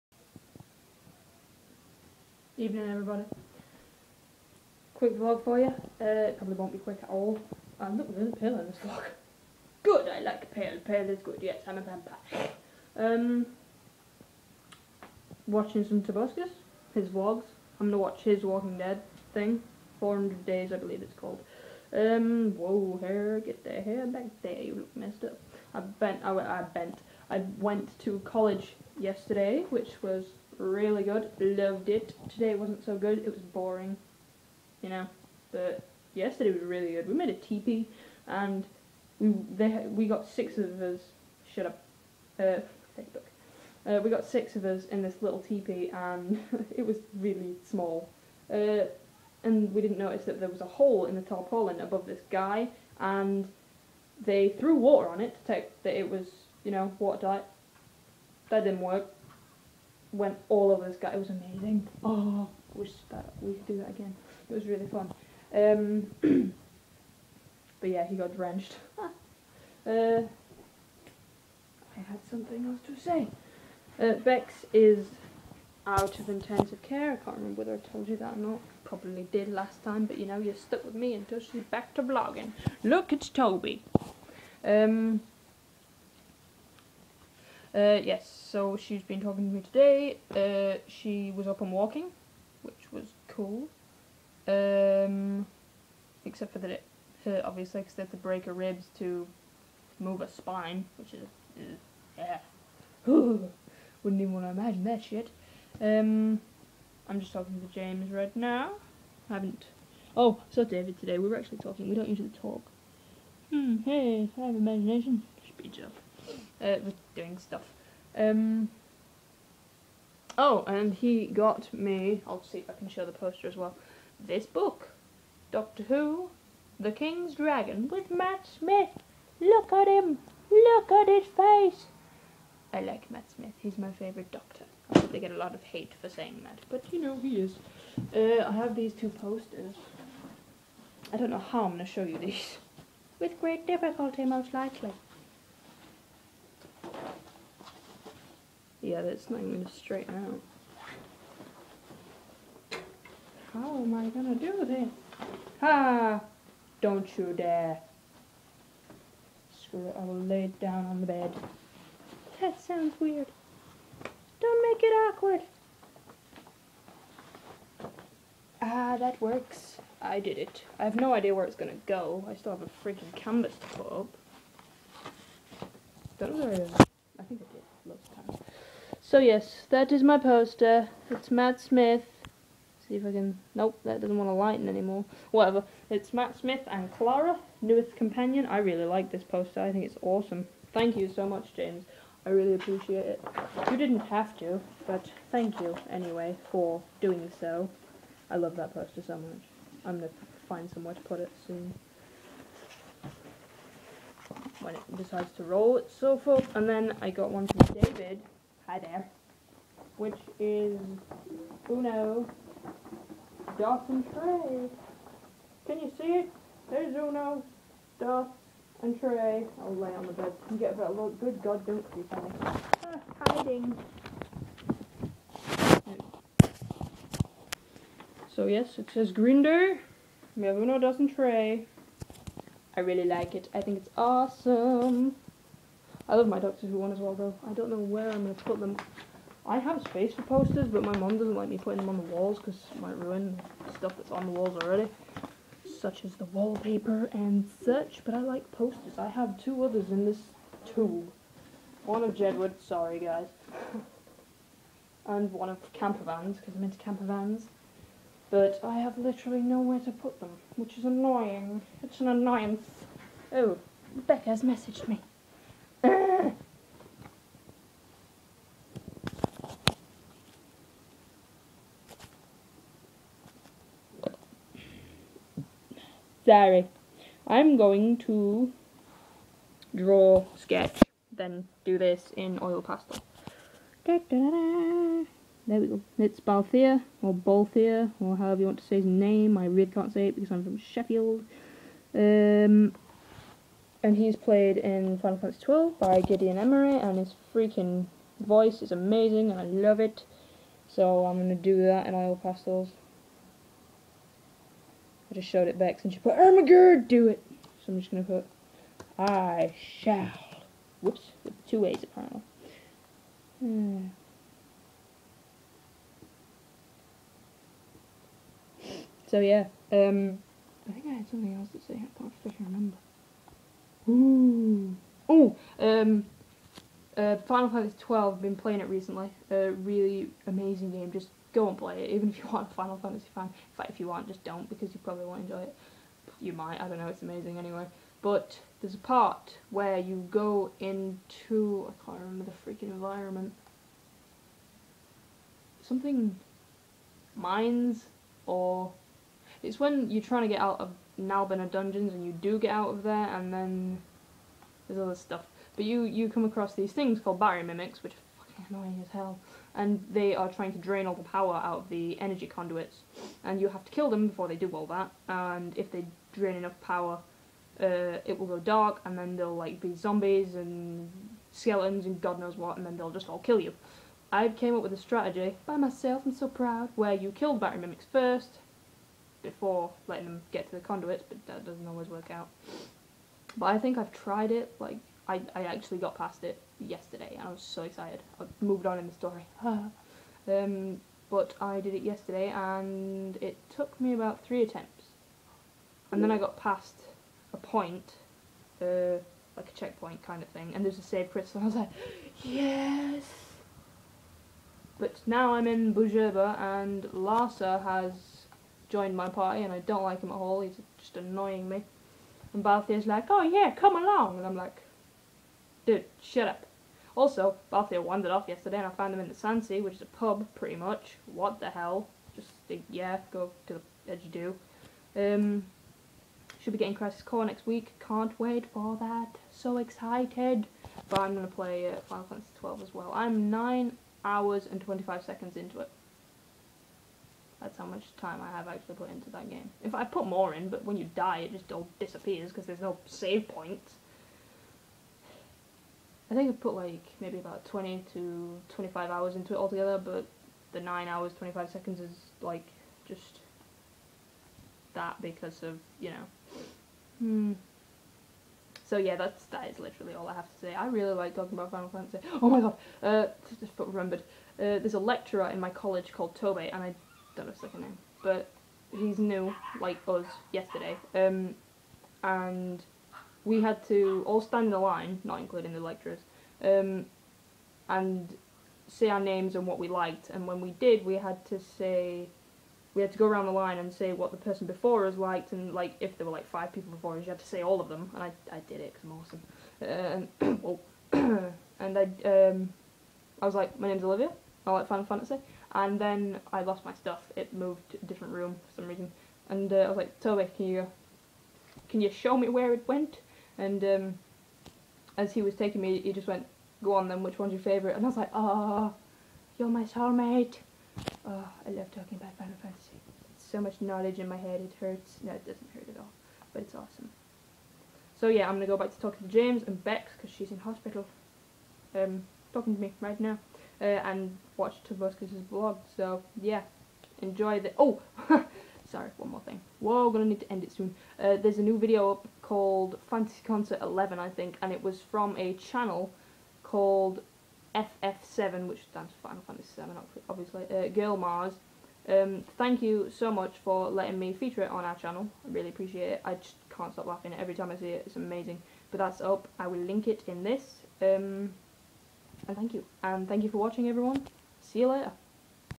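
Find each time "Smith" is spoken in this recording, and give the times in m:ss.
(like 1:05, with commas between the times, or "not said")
2:08, 2:13, 3:01, 3:06.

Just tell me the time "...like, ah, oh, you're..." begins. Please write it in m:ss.
8:27.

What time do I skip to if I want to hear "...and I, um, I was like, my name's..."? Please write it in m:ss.
8:11.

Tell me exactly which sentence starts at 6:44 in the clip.
But now I'm in Bhujerba and Larsa has joined my party and I don't like him at all, he's just annoying me.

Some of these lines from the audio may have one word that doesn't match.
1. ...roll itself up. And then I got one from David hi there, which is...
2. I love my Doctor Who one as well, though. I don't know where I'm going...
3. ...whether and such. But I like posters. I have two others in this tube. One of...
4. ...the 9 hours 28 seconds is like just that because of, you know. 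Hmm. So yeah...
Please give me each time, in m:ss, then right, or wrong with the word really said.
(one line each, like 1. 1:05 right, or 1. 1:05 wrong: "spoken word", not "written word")
1. 3:25 right
2. 3:56 right
3. 4:06 wrong: "wallpaper", not "whether"
4. 7:30 wrong: "25", not "28".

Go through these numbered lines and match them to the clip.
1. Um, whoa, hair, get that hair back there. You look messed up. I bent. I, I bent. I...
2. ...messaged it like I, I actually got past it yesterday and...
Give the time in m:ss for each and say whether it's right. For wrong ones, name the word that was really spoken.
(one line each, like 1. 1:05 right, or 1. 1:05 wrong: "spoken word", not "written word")
1. 0:21 right
2. 6:23 wrong: "tried", not "messaged".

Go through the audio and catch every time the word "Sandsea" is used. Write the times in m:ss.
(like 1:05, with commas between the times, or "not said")
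6:59.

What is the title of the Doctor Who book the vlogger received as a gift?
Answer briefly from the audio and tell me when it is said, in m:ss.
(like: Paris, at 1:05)
The King's Dragon, at 2:06.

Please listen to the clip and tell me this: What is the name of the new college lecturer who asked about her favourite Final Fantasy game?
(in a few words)
Tobey.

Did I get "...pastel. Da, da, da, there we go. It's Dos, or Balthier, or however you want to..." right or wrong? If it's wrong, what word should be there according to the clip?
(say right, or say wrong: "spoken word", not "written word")
wrong: "Balthier", not "Dos".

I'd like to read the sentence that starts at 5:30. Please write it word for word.
Just go and play it, even if you aren't a Final Fantasy fan.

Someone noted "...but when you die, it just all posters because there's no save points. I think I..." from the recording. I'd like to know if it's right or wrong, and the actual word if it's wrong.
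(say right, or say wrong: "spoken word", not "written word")
wrong: "disappears", not "posters".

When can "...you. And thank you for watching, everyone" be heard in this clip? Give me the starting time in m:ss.
9:12.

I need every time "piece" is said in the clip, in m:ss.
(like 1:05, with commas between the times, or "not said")
not said.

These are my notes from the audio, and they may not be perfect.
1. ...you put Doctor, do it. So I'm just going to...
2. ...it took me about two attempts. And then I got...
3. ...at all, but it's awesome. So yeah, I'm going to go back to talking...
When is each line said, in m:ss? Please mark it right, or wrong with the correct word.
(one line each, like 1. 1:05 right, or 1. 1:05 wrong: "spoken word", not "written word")
1. 5:05 wrong: "Ermagerd", not "Doctor"
2. 6:33 wrong: "three", not "two"
3. 8:35 right.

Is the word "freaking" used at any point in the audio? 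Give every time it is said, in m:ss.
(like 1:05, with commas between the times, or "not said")
2:52, 4:57, 5:42.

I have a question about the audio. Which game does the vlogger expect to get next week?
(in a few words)
Crisis Core.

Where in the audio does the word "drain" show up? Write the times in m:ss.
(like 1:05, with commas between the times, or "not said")
6:00, 6:06.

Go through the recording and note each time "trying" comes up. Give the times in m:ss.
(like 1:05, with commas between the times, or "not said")
5:50, 6:00.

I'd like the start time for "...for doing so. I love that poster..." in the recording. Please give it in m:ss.
3:16.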